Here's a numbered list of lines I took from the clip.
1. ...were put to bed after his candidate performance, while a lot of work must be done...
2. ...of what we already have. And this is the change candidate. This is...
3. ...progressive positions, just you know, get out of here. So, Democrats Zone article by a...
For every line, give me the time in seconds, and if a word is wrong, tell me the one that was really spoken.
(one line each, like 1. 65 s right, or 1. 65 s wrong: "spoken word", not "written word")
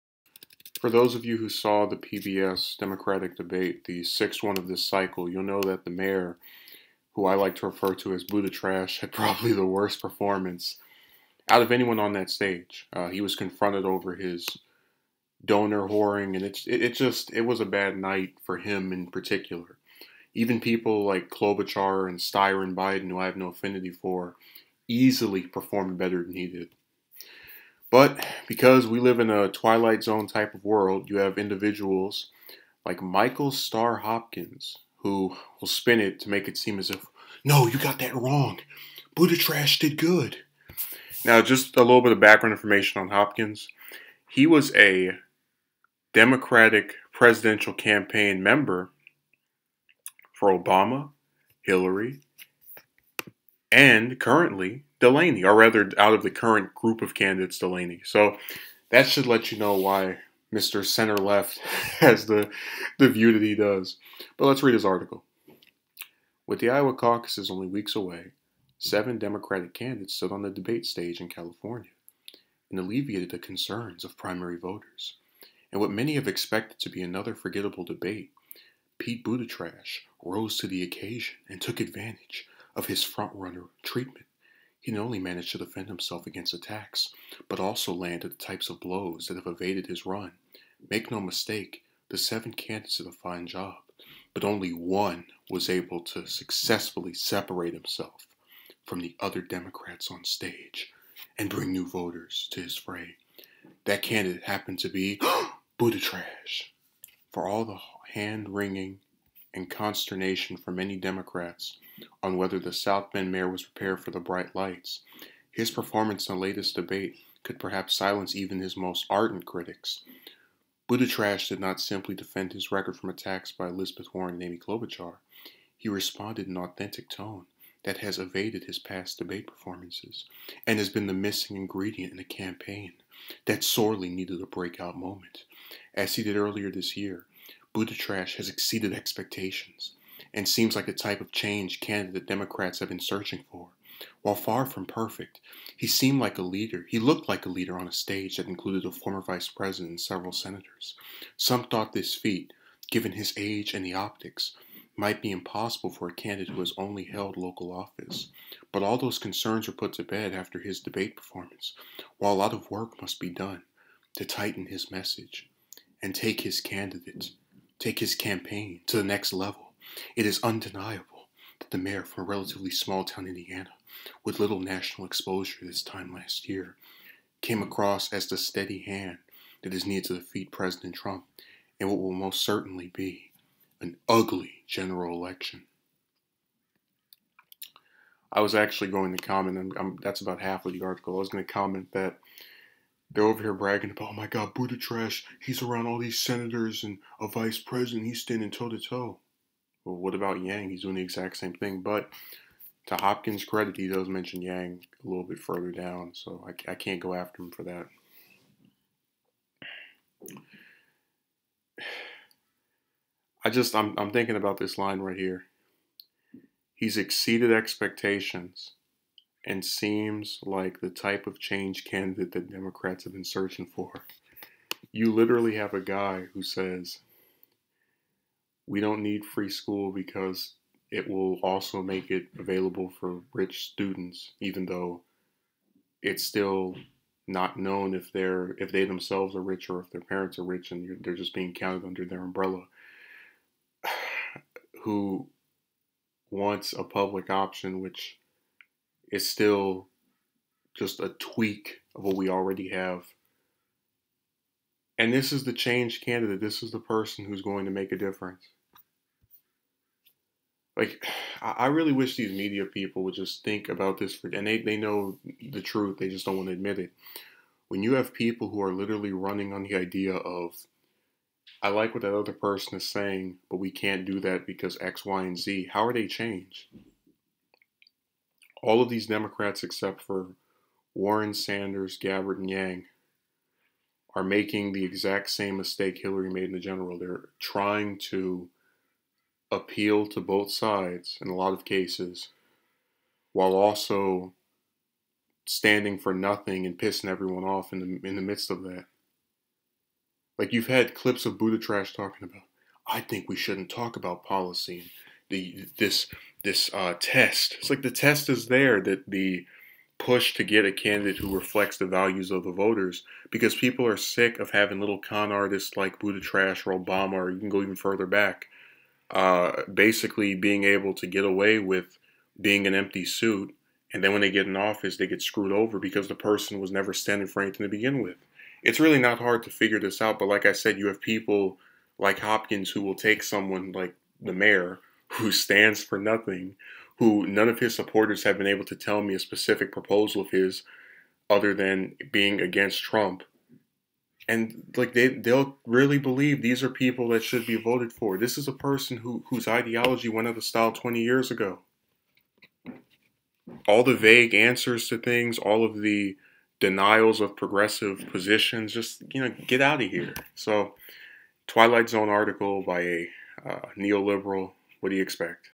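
1. 159 s wrong: "debate", not "candidate"
2. 251 s right
3. 357 s wrong: "Twilight", not "Democrats".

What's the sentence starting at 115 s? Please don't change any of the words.
His performance in the latest debate could perhaps silence even his most ardent critics.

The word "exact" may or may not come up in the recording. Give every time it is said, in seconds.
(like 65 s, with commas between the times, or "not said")
201 s, 284 s.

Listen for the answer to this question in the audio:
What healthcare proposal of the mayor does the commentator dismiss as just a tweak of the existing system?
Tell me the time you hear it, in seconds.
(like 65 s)
246 s.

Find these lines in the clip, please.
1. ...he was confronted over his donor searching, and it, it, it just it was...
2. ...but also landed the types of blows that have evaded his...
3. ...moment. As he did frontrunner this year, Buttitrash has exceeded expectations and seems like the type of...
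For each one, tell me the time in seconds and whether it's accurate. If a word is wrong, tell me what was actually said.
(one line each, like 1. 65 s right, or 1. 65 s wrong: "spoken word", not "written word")
1. 13 s wrong: "whoring", not "searching"
2. 87 s right
3. 134 s wrong: "earlier", not "frontrunner".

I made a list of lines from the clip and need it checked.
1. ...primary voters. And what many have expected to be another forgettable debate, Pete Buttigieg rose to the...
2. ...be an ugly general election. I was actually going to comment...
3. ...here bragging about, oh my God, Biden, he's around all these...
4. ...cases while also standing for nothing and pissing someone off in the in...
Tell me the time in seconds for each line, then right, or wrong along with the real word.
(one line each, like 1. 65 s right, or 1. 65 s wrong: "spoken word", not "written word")
1. 74 s right
2. 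182 s right
3. 193 s wrong: "Buttitrash", not "Biden"
4. 291 s wrong: "everyone", not "someone".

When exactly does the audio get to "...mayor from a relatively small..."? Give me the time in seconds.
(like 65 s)
171 s.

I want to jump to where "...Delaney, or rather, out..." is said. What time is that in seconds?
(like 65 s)
55 s.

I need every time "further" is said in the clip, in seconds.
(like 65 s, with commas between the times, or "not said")
205 s, 317 s.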